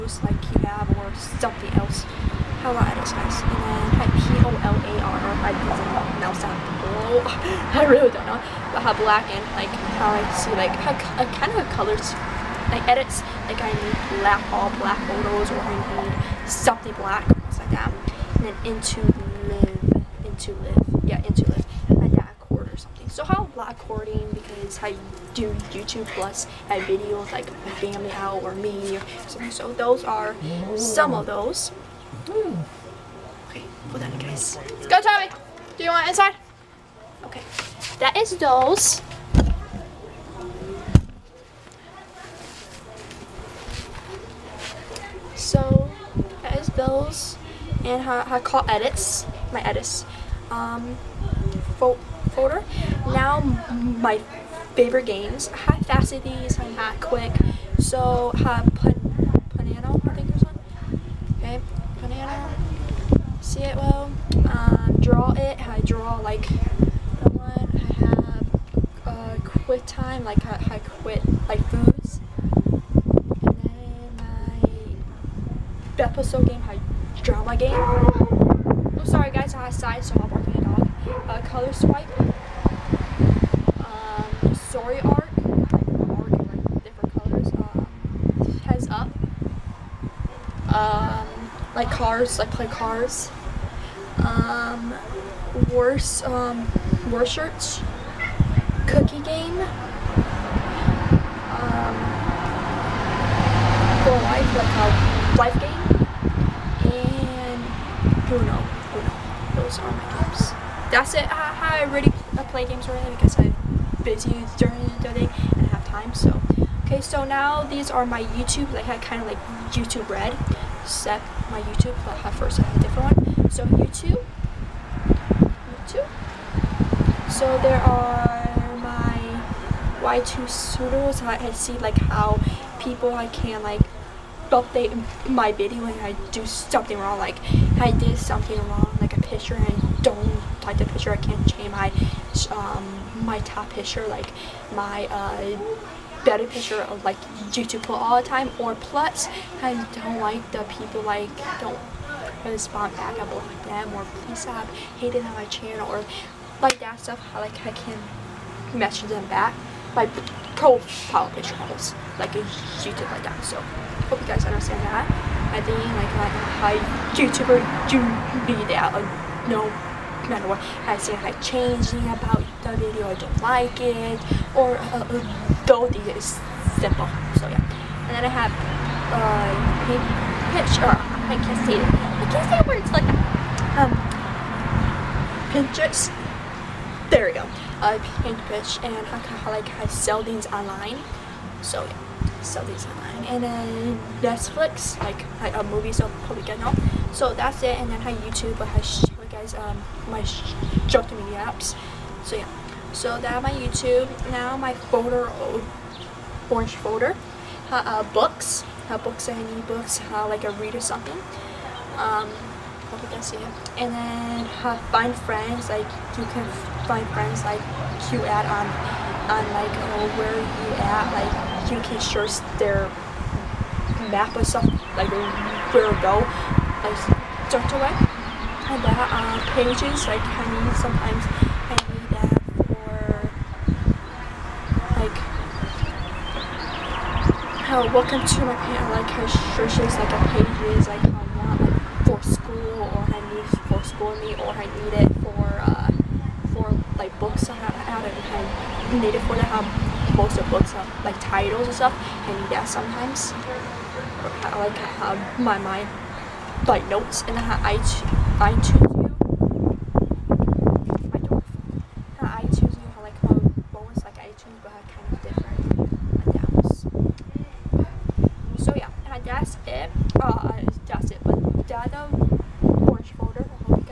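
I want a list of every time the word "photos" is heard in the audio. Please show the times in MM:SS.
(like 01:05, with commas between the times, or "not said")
00:15.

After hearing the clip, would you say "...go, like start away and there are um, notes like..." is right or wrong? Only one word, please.
wrong.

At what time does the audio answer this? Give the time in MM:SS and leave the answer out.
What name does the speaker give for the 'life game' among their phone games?
01:44.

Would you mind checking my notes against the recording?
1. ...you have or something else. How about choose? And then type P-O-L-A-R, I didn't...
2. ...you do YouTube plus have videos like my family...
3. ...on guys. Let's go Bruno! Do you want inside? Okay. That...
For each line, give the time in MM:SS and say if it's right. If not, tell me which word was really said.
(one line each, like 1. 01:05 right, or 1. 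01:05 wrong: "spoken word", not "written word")
1. 00:00 wrong: "exercise", not "choose"
2. 00:24 right
3. 00:34 wrong: "Tommy", not "Bruno".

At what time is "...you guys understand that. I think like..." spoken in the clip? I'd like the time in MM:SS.
02:44.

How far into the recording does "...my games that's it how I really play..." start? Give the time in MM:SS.
01:49.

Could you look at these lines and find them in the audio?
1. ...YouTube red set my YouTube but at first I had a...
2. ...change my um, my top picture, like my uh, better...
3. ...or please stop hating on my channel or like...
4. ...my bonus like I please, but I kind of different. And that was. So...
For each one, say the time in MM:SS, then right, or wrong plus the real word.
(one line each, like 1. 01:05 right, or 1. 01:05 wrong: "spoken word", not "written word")
1. 01:59 right
2. 02:21 right
3. 02:33 right
4. 04:23 wrong: "choose", not "please".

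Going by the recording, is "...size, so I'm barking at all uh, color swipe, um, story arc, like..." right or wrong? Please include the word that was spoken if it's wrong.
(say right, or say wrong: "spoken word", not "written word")
right.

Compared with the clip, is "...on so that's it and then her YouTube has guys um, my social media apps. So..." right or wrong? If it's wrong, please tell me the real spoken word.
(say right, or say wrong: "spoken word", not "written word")
right.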